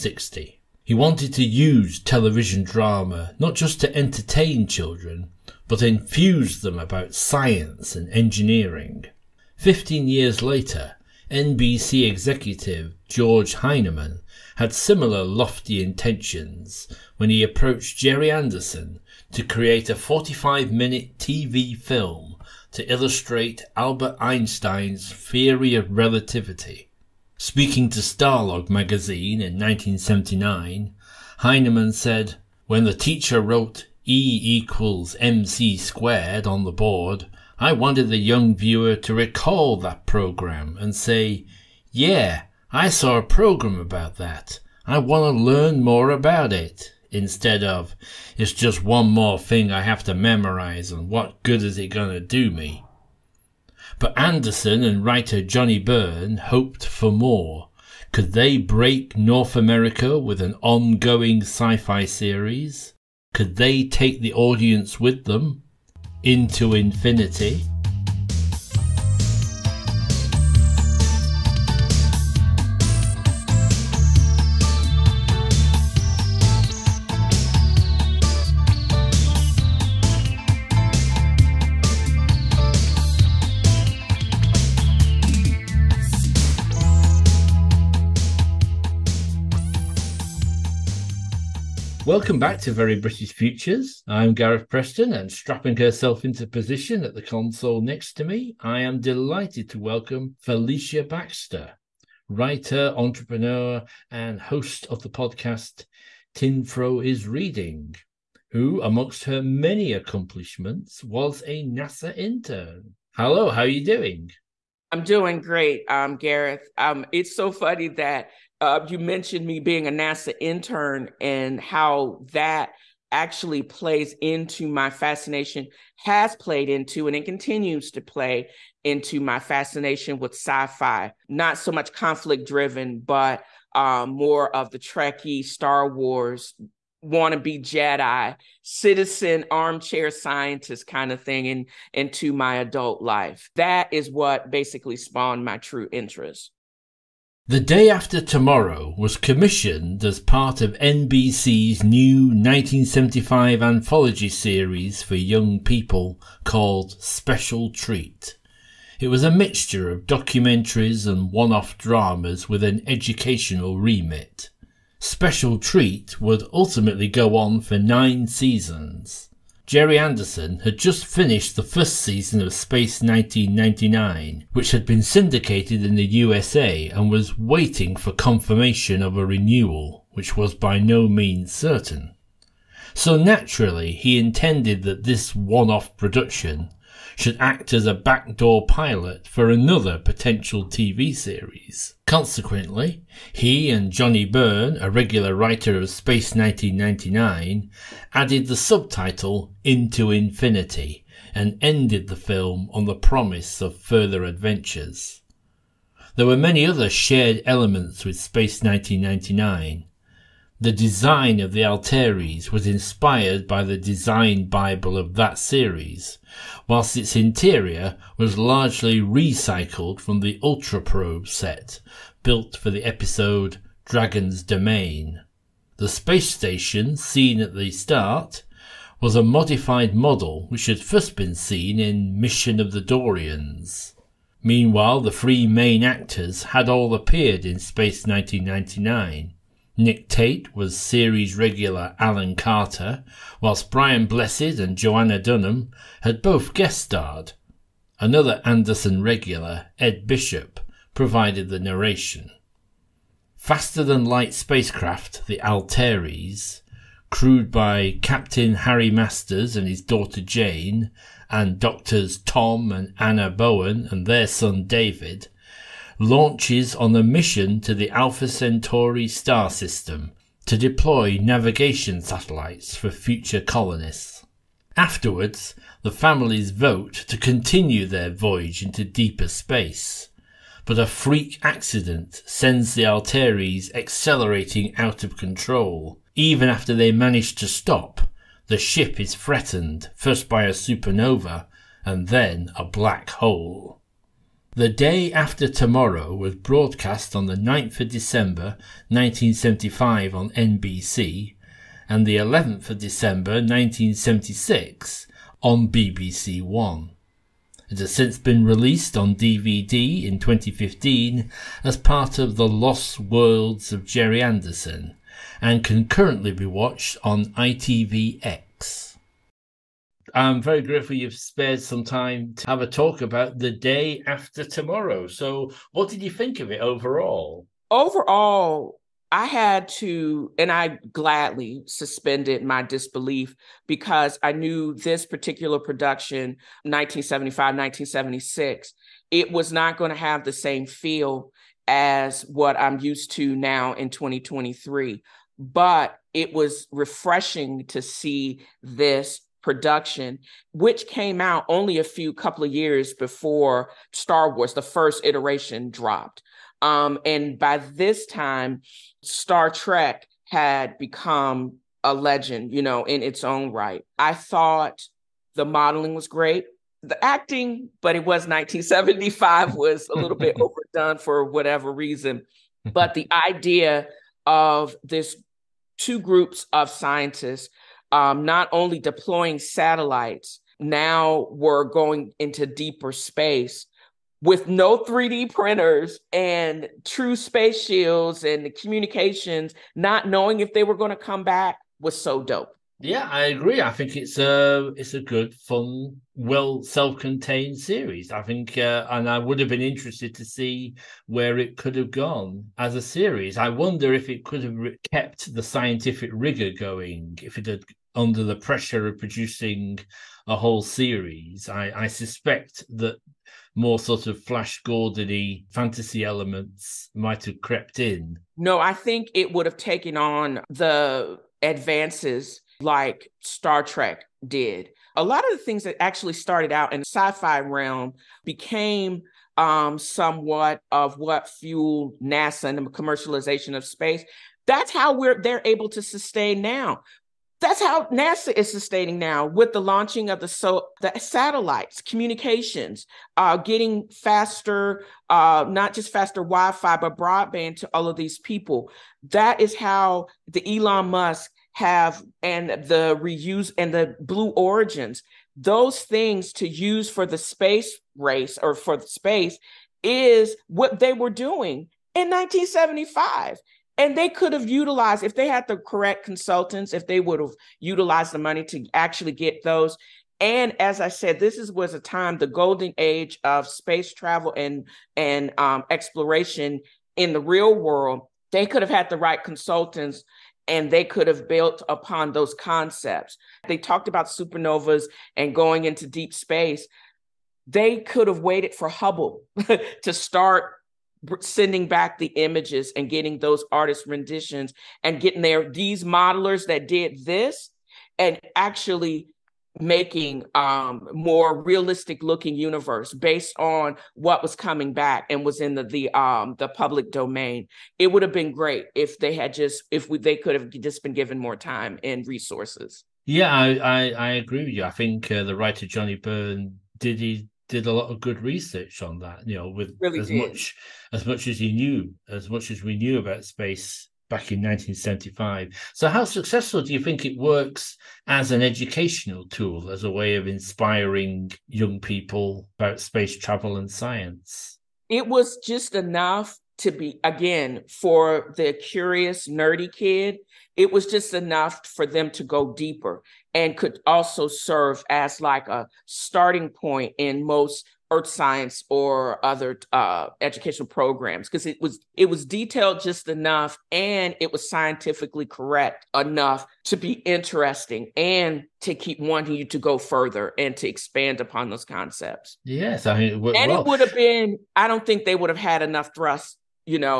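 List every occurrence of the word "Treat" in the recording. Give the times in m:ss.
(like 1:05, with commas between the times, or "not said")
2:37, 2:45.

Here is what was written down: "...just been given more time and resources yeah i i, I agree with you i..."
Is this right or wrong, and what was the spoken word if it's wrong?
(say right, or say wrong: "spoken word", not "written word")
right.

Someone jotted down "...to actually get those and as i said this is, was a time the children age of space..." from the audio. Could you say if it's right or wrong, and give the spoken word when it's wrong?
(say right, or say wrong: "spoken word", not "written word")
wrong: "golden", not "children".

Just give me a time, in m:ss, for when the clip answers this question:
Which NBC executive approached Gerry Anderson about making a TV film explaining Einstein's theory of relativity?
0:13.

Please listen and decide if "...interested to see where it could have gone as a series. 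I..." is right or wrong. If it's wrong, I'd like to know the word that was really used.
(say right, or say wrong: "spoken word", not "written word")
right.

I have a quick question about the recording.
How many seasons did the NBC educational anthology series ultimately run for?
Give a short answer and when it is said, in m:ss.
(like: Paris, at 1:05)
9, at 2:47.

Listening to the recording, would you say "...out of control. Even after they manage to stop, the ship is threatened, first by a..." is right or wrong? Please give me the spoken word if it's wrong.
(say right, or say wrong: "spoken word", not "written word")
right.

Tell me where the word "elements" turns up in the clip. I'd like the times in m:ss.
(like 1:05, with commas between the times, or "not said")
3:27, 6:56.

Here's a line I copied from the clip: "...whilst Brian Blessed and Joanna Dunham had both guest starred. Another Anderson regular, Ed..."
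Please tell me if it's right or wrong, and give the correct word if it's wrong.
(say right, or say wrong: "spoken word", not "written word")
right.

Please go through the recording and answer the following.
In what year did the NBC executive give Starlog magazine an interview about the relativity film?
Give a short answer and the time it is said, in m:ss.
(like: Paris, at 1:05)
1979, at 0:29.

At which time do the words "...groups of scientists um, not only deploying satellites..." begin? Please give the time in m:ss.
6:16.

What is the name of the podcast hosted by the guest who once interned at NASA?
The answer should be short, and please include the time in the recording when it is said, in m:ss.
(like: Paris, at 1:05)
Tinfro is Reading, at 1:46.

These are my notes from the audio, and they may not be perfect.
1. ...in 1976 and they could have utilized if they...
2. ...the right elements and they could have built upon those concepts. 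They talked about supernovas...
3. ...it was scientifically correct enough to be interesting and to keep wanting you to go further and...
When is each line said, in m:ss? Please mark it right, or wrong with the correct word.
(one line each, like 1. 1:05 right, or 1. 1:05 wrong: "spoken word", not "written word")
1. 7:41 wrong: "1975", not "1976"
2. 7:58 wrong: "consultants", not "elements"
3. 9:14 right.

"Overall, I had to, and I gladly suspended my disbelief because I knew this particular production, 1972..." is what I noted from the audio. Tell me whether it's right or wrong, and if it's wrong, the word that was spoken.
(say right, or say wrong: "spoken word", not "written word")
wrong: "1975", not "1972".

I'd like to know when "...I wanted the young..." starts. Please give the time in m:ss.
0:37.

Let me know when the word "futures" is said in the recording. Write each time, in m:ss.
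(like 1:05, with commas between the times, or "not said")
1:33, 4:32.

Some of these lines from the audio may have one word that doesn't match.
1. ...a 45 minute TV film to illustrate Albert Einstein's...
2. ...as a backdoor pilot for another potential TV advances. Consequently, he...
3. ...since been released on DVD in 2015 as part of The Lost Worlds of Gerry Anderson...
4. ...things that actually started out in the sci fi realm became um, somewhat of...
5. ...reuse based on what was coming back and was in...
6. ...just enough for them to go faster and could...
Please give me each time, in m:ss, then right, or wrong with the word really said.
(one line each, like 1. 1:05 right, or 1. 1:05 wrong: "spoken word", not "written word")
1. 0:19 right
2. 3:07 wrong: "series", not "advances"
3. 5:07 right
4. 7:05 right
5. 8:22 wrong: "universe", not "reuse"
6. 9:00 wrong: "deeper", not "faster".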